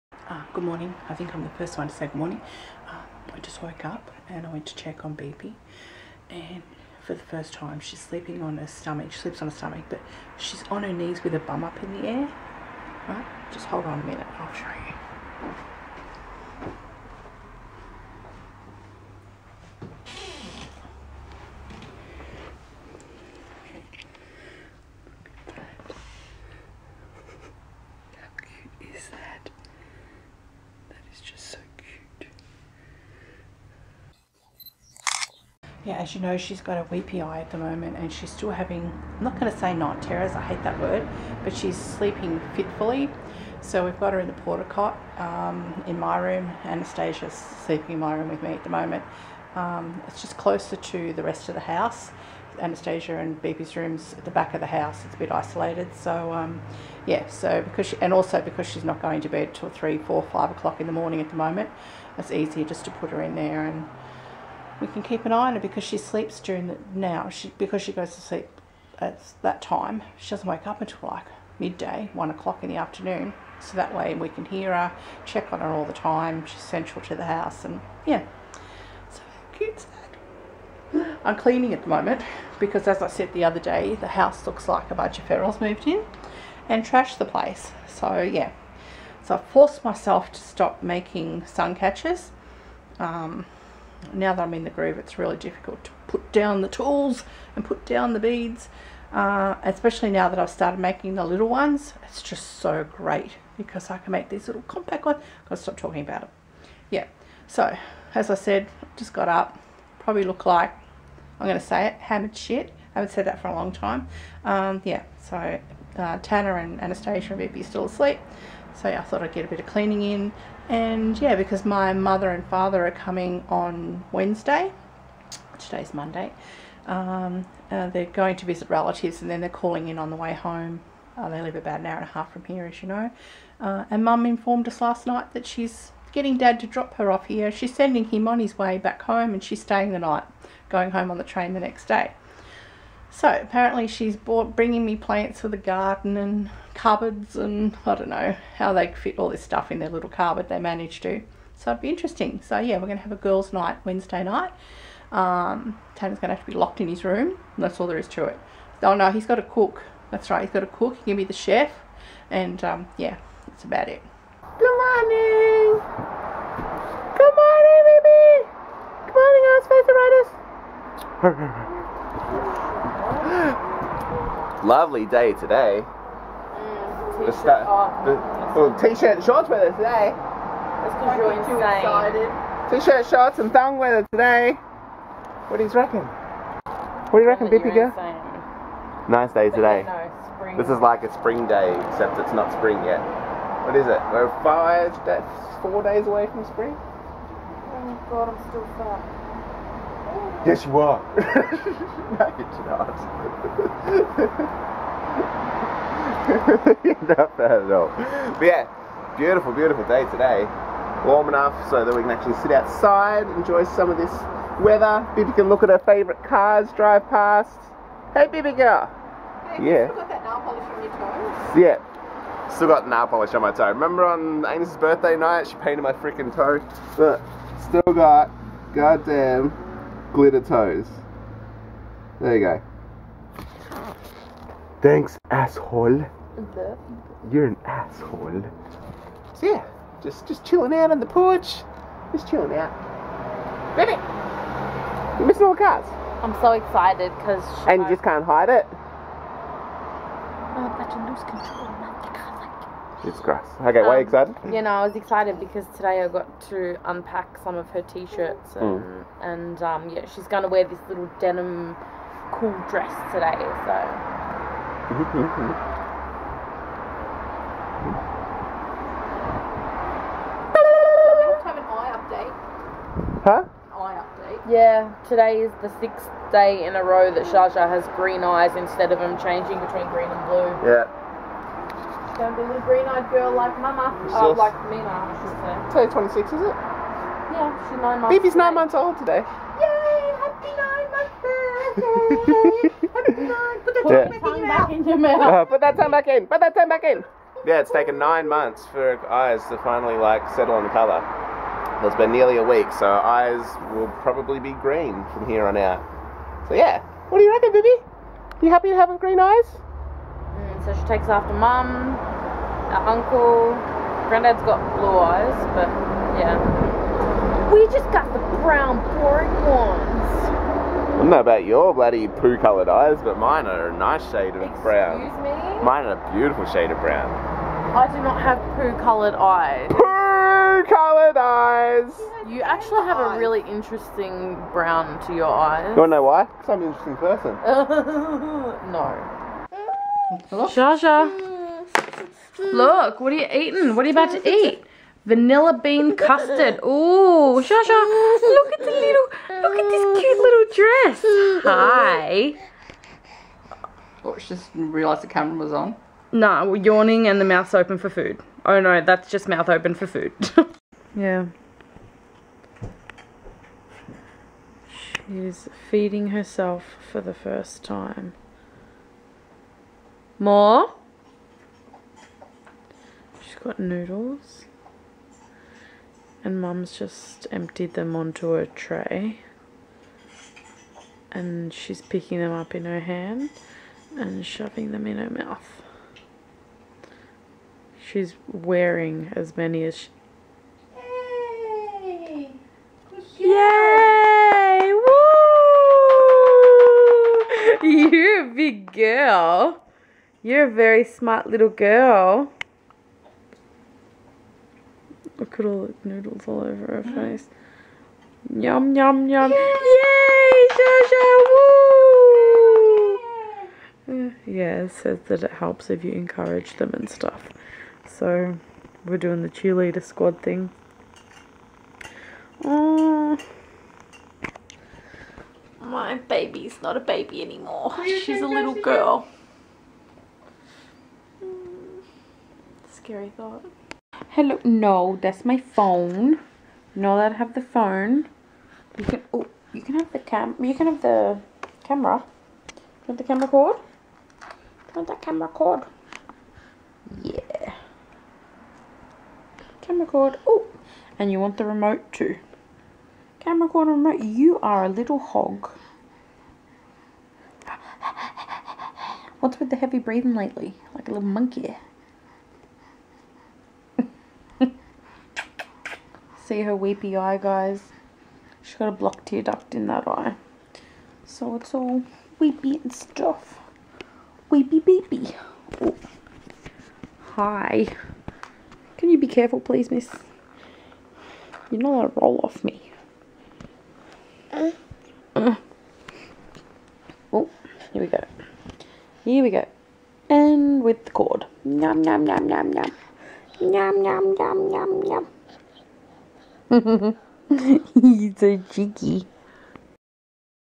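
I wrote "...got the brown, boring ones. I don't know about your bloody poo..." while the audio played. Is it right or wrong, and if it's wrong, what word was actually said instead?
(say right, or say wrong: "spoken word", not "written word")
right.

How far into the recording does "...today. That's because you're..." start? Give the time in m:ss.
2:59.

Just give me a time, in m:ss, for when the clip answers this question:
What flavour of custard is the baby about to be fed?
5:45.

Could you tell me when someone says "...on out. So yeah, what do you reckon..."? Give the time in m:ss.
5:05.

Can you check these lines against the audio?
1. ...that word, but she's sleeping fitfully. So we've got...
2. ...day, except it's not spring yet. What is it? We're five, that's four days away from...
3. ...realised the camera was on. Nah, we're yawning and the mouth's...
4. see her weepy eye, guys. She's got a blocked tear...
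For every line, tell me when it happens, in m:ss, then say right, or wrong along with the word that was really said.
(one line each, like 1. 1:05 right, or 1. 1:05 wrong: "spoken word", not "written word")
1. 0:40 right
2. 3:11 right
3. 5:54 right
4. 7:46 right.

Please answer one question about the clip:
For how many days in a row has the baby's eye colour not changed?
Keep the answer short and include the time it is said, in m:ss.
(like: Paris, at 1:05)
6, at 4:35.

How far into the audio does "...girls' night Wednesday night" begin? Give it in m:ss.
2:33.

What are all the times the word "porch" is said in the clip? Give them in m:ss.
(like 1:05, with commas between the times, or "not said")
4:01.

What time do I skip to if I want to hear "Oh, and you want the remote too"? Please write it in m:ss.
7:30.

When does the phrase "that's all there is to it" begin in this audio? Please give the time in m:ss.
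2:37.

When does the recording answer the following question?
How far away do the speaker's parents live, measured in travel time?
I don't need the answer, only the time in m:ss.
2:11.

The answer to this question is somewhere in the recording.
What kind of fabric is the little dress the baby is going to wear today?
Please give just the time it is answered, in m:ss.
4:21.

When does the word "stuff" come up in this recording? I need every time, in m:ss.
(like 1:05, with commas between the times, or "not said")
2:29, 6:56, 7:52.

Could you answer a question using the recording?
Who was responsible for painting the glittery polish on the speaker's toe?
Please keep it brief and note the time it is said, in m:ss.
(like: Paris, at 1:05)
Amy, at 3:44.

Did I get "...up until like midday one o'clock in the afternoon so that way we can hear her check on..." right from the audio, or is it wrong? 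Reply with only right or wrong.
right.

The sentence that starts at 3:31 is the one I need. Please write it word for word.
Warm enough so that we can actually sit outside, enjoy some of this weather.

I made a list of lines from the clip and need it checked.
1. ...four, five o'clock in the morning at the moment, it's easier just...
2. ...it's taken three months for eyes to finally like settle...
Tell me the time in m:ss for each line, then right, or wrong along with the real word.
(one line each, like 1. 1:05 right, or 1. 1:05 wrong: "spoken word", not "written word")
1. 0:59 right
2. 4:57 wrong: "nine", not "three".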